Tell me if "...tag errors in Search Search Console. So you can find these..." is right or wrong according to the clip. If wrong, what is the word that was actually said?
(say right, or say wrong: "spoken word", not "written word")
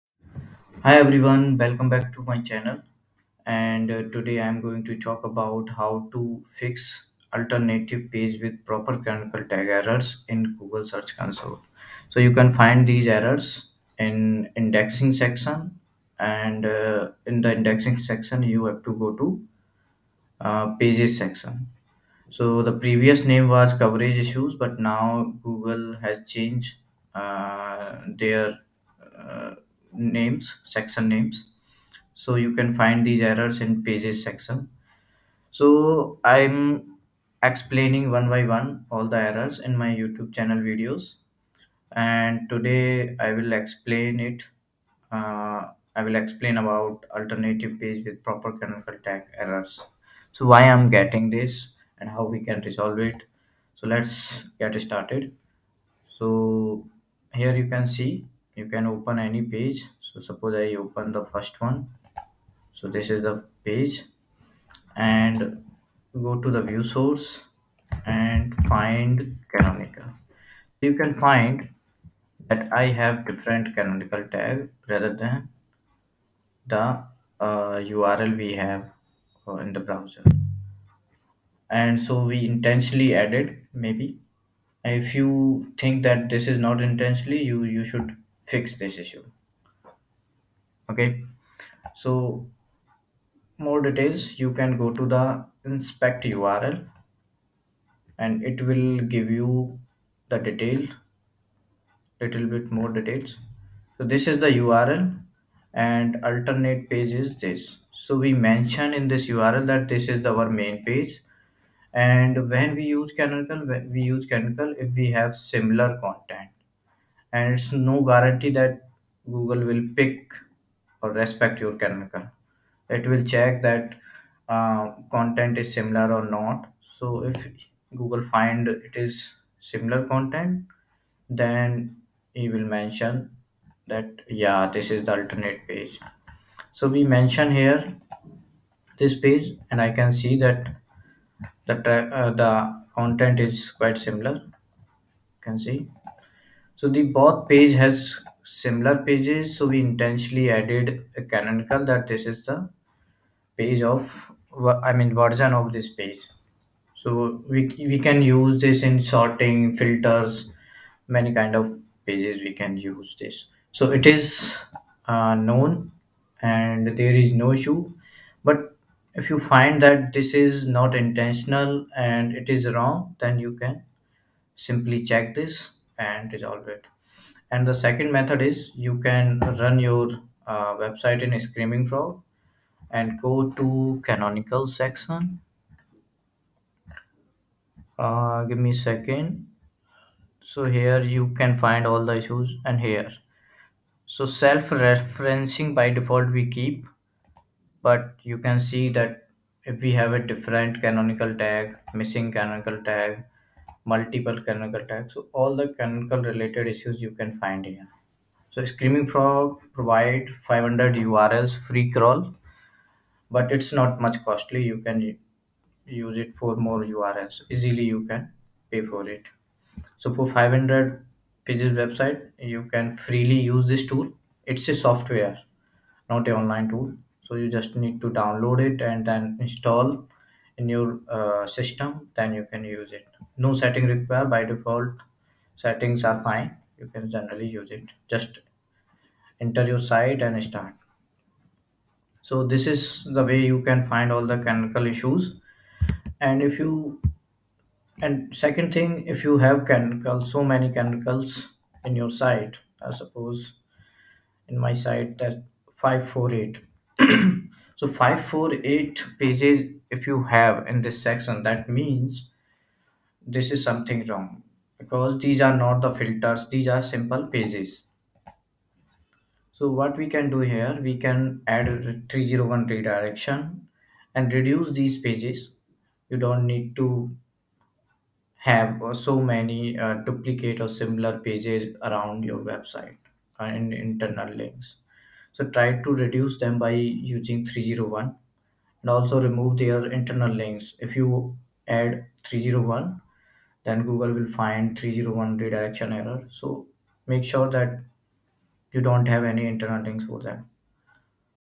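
wrong: "Google", not "Search".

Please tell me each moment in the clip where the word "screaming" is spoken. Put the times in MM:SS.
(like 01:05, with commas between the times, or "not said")
03:01, 03:28.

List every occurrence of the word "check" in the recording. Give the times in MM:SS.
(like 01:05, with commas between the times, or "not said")
02:03, 02:55.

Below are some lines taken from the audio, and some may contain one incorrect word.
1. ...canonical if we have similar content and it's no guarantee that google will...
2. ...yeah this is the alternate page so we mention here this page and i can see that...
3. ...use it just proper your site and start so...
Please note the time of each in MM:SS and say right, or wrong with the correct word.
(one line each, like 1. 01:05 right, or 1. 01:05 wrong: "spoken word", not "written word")
1. 01:54 right
2. 02:14 right
3. 03:57 wrong: "enter", not "proper".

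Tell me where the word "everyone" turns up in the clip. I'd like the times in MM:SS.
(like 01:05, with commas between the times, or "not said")
00:00.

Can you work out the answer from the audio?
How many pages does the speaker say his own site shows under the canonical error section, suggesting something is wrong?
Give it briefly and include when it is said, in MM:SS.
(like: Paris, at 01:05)
548, at 04:17.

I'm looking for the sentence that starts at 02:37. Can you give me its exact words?
So we we can use this in sorting filters, many kind of pages we can use this.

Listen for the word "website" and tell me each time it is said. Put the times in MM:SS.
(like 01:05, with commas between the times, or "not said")
03:00, 03:41, 04:42.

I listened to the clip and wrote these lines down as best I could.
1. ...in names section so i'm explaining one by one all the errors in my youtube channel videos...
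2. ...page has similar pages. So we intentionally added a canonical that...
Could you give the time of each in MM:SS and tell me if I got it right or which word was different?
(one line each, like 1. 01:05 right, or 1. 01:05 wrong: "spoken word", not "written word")
1. 00:33 wrong: "pages", not "names"
2. 02:27 right.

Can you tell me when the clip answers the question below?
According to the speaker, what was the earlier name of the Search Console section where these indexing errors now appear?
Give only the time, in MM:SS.
00:23.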